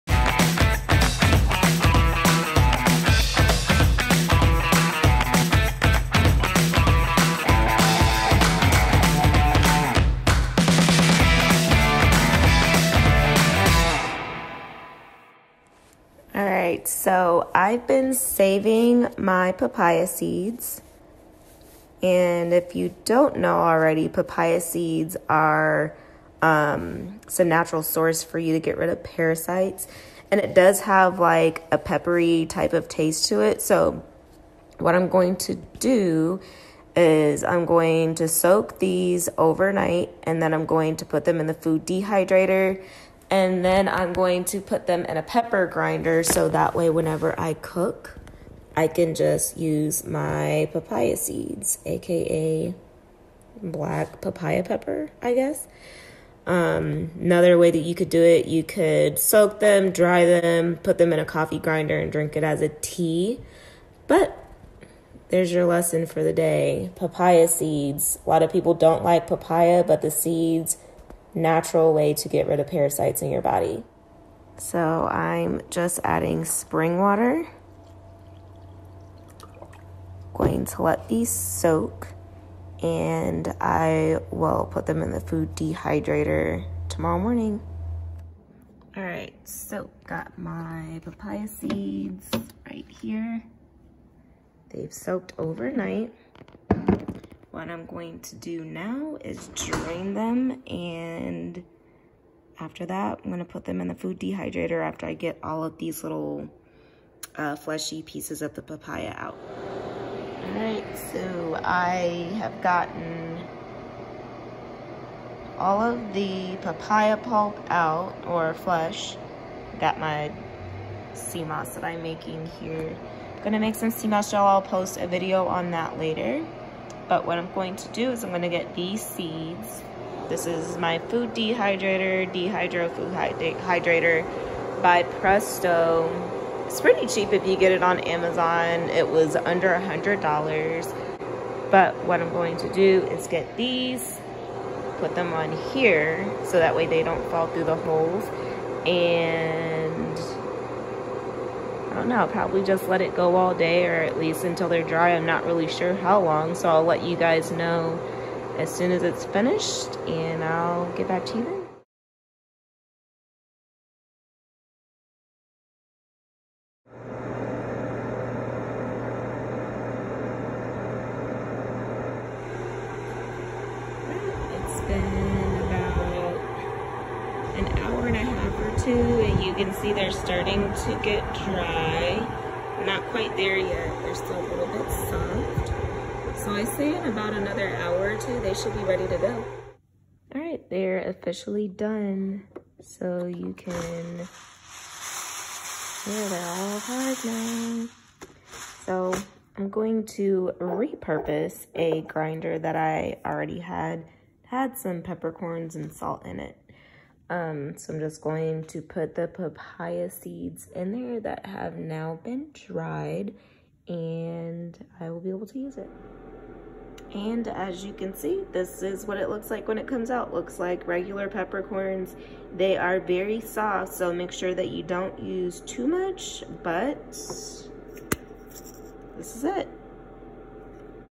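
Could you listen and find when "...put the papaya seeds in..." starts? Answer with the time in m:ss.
3:28.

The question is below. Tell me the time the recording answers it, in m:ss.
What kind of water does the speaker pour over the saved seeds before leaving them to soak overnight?
1:16.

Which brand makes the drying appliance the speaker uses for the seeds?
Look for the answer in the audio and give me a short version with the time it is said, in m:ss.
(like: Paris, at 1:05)
Presto, at 2:15.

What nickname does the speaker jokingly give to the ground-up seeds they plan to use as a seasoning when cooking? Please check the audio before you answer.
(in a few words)
black papaya pepper.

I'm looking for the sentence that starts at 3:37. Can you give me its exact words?
And as you can see, this is what it looks like when it comes out.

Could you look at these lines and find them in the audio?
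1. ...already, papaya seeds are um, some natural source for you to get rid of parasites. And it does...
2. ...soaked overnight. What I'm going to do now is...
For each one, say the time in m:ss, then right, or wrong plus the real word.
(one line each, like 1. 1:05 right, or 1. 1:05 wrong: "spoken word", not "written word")
1. 0:23 right
2. 1:34 right.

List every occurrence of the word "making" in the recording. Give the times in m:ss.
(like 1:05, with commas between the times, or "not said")
2:02.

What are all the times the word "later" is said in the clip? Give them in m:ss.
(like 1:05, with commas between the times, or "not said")
2:05.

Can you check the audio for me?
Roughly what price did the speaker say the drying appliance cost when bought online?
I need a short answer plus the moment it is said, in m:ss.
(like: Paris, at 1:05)
under $100, at 2:19.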